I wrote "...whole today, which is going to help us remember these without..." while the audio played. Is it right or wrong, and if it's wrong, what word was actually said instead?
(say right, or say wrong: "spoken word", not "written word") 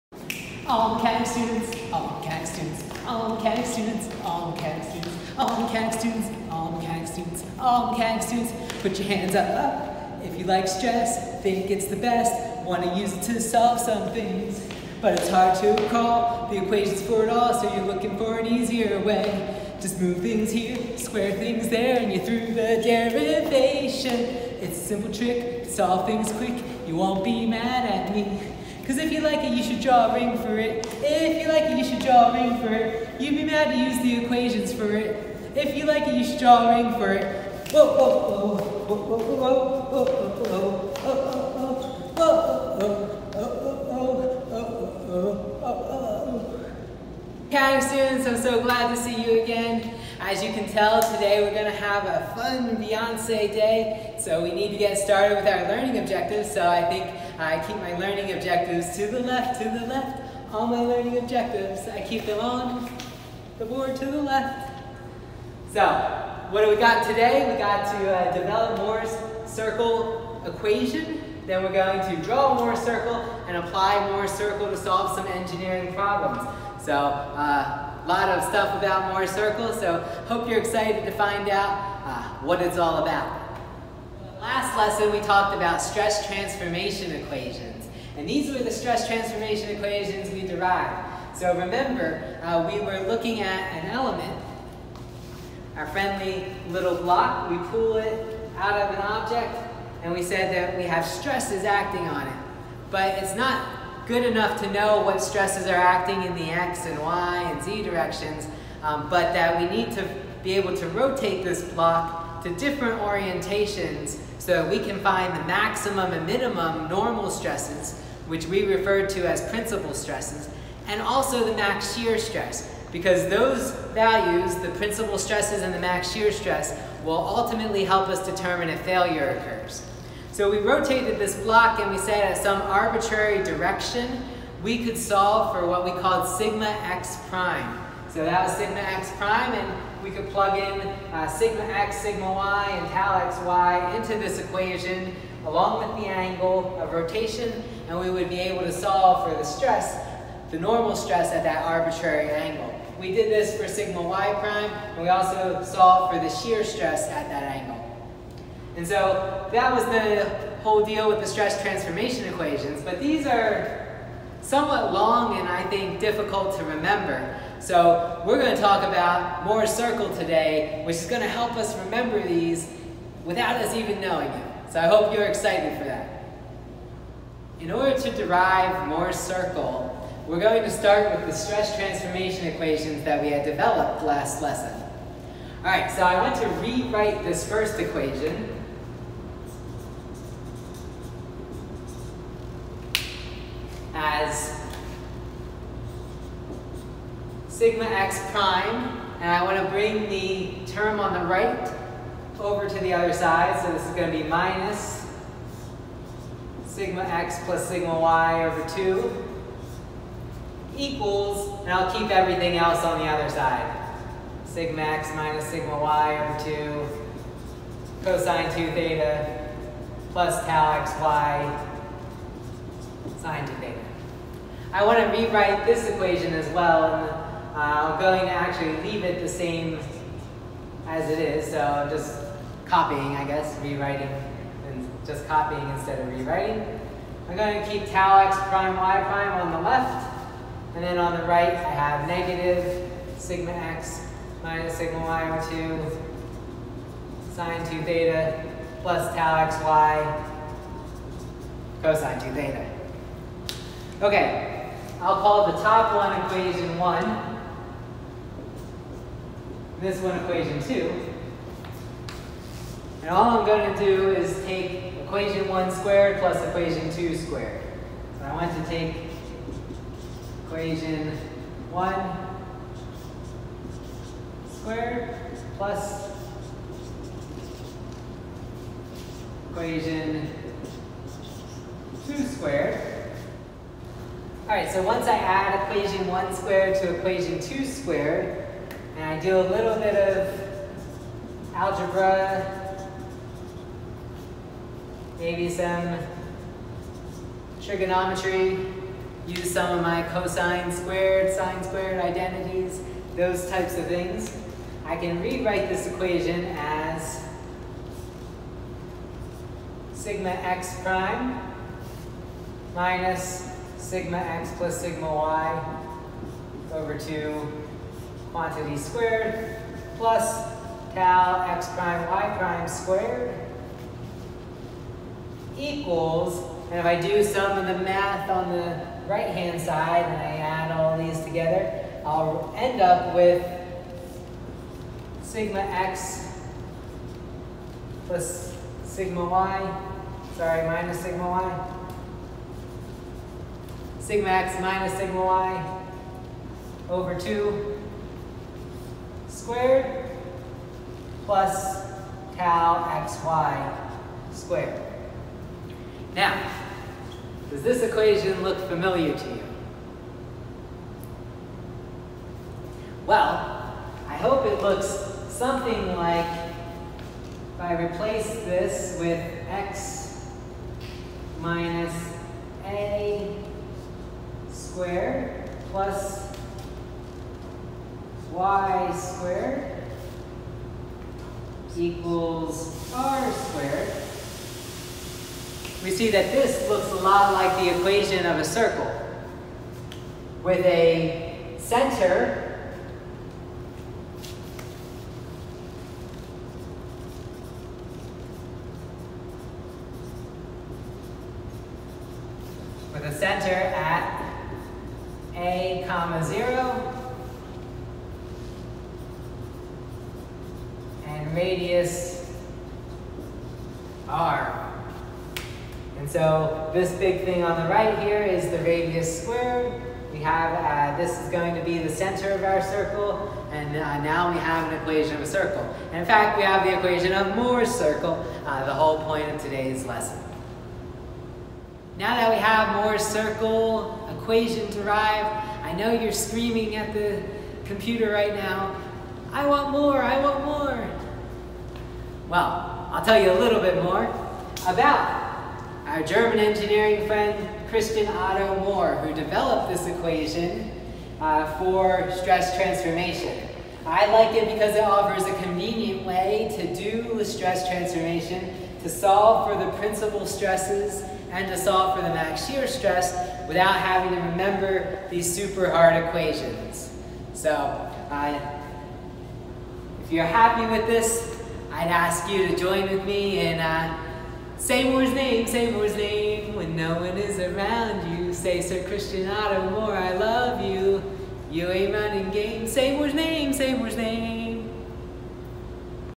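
wrong: "circle", not "whole".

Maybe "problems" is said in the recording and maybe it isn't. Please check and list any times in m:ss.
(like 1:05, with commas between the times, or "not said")
1:15.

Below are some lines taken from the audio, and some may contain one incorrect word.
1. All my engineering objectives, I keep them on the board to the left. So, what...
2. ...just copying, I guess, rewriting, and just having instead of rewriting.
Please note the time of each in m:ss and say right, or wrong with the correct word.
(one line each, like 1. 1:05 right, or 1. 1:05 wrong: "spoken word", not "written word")
1. 1:00 wrong: "learning", not "engineering"
2. 3:51 wrong: "copying", not "having".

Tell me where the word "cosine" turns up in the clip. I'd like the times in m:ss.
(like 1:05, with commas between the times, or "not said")
3:38, 4:11, 5:00.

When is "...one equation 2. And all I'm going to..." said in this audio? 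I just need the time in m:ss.
4:20.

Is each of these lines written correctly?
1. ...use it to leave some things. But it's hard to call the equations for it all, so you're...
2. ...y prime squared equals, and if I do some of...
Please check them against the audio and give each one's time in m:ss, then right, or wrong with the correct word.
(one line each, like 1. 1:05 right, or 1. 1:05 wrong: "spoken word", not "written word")
1. 0:12 wrong: "solve", not "leave"
2. 5:22 right.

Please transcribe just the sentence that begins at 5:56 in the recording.
Now, does this equation look familiar to you?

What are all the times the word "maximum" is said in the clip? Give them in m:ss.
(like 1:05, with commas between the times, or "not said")
1:55.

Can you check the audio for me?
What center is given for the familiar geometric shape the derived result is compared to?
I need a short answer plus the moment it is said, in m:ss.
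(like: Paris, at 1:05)
a comma zero, at 6:45.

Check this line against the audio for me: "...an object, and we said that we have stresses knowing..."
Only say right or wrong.
wrong.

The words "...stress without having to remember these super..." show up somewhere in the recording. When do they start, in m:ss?
7:42.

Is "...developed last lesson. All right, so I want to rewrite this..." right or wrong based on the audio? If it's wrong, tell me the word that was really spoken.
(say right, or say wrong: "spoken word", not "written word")
right.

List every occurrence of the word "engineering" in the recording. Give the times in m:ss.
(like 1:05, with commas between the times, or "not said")
1:15, 7:26.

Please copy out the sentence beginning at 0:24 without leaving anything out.
It's a simple trick, solve things quick, you won't be mad at me.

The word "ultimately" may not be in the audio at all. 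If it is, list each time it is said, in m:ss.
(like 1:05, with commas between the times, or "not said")
2:07.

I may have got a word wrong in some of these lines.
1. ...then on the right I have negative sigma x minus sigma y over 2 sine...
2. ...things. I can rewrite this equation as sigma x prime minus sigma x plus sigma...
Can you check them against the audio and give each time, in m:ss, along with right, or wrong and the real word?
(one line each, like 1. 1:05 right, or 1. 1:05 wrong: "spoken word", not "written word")
1. 4:00 right
2. 5:03 right.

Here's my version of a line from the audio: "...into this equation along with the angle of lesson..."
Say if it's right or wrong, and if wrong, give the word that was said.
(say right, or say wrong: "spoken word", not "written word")
wrong: "rotation", not "lesson".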